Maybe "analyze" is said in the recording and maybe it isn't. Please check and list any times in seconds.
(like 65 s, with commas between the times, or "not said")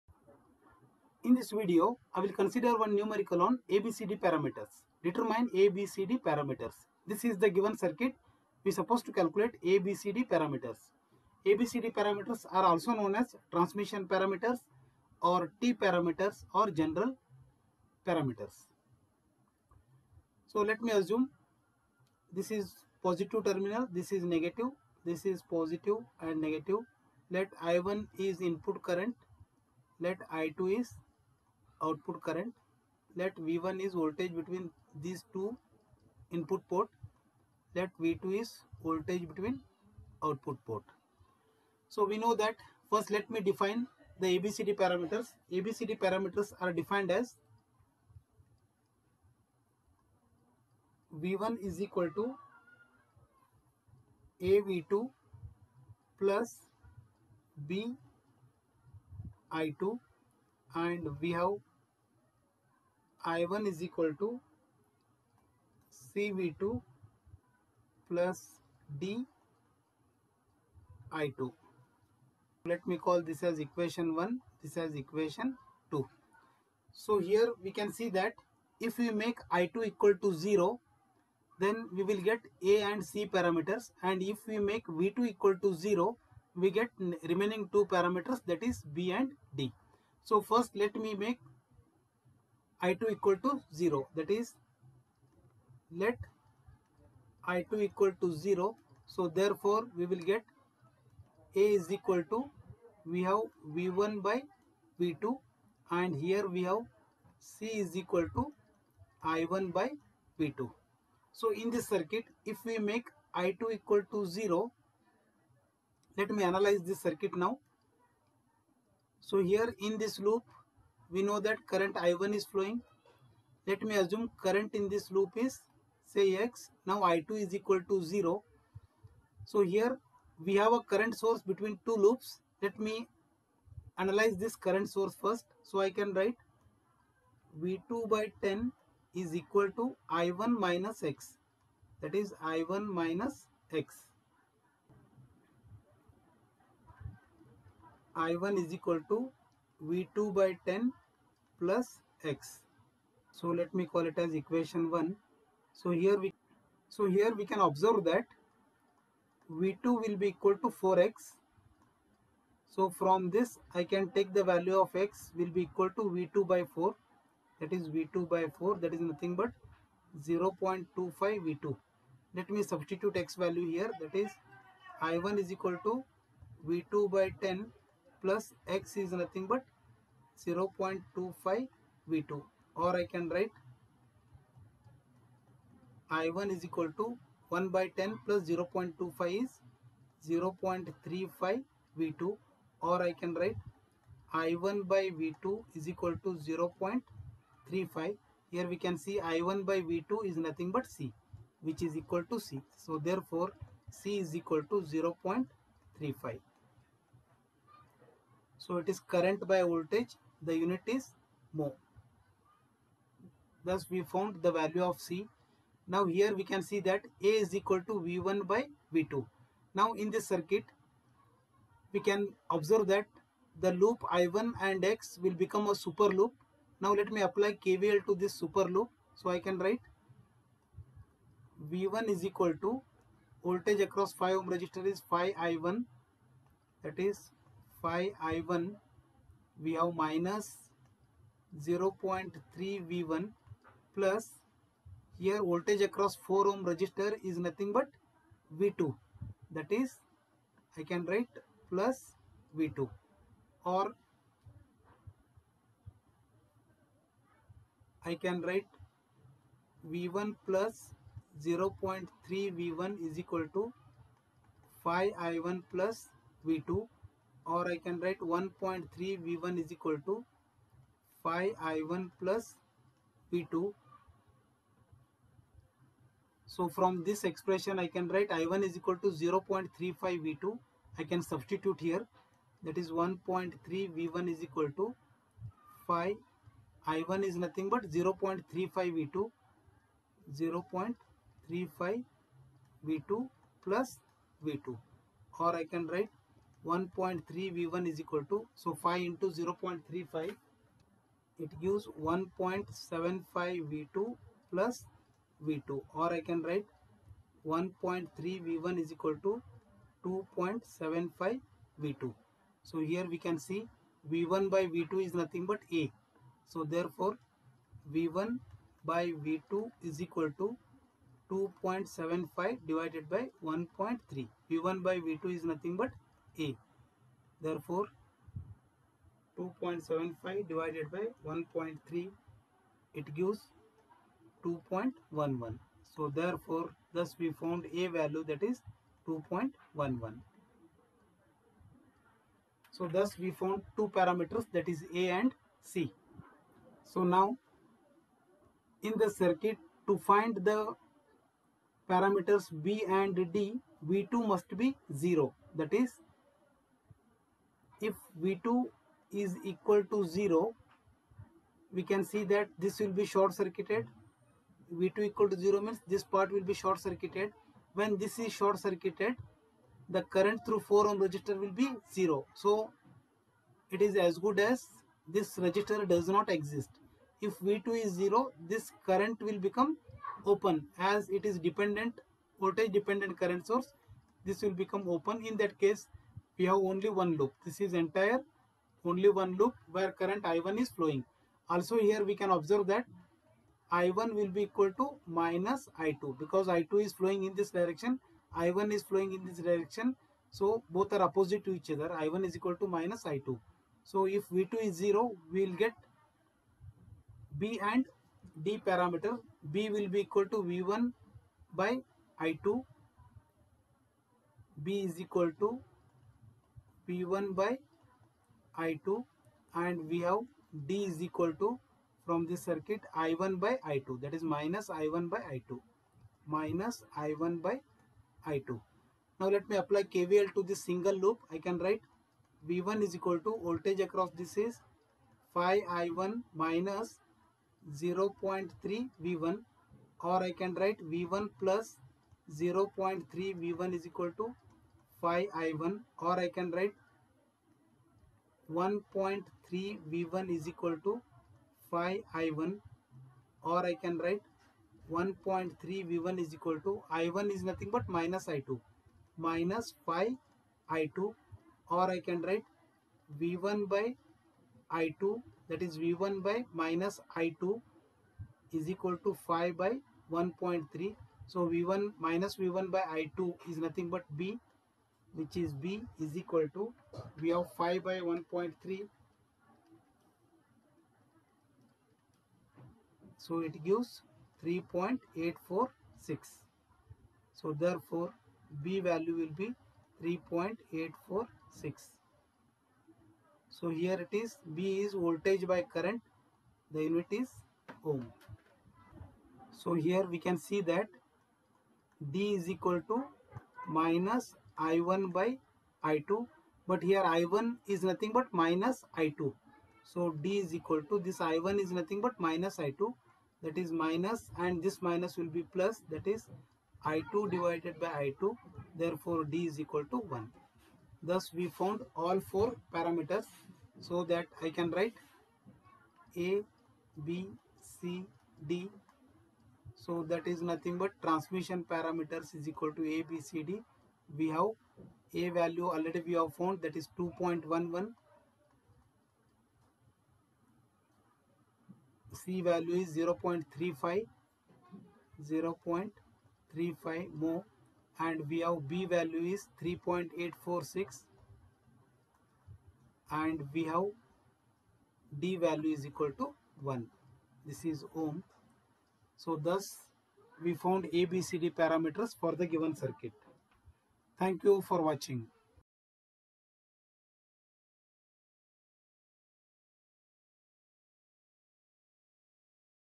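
116 s, 133 s.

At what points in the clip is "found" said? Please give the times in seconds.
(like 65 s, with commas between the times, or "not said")
214 s, 337 s, 343 s, 521 s, 536 s, 560 s.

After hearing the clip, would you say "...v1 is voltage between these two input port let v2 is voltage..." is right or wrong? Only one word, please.
right.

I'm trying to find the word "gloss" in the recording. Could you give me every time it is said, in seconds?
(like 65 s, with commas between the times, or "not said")
not said.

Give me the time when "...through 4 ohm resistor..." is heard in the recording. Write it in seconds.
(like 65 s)
370 s.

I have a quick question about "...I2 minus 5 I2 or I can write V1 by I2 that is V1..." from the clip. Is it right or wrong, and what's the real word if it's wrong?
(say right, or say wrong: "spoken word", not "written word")
right.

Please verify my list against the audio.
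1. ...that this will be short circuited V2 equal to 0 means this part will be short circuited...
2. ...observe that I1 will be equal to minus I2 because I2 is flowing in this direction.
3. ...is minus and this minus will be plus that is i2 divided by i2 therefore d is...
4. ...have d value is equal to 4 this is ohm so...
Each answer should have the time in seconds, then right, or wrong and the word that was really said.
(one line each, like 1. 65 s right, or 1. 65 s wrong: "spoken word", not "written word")
1. 362 s right
2. 392 s right
3. 513 s right
4. 553 s wrong: "1", not "4".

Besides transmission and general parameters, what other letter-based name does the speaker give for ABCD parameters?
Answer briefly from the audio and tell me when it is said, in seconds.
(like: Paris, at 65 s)
T parameters, at 15 s.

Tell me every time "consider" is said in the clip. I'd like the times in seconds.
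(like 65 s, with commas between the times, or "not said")
2 s.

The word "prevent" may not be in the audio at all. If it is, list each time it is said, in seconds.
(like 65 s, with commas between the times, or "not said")
not said.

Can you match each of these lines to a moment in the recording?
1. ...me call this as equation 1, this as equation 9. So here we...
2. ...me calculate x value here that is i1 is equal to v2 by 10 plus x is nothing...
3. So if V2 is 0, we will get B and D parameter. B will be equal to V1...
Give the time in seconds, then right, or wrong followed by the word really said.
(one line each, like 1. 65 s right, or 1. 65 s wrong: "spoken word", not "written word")
1. 72 s wrong: "2", not "9"
2. 172 s wrong: "substitute", not "calculate"
3. 403 s right.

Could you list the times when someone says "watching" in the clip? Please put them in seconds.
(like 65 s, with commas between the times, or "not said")
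564 s.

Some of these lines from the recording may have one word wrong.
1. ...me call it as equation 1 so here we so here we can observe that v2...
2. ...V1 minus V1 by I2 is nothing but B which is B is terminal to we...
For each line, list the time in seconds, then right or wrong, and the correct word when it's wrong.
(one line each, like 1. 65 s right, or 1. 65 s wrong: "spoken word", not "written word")
1. 153 s right
2. 471 s wrong: "equal", not "terminal".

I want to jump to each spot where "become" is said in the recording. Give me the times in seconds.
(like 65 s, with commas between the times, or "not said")
225 s, 379 s, 384 s.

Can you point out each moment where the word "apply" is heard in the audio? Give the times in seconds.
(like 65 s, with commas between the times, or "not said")
227 s, 429 s.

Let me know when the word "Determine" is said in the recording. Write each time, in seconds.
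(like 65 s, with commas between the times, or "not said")
5 s.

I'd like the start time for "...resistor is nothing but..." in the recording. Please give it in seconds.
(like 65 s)
246 s.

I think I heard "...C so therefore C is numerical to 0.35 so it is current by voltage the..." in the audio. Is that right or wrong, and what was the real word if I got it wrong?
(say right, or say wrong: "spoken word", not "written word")
wrong: "equal", not "numerical".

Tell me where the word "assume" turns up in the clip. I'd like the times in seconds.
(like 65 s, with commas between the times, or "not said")
20 s, 123 s.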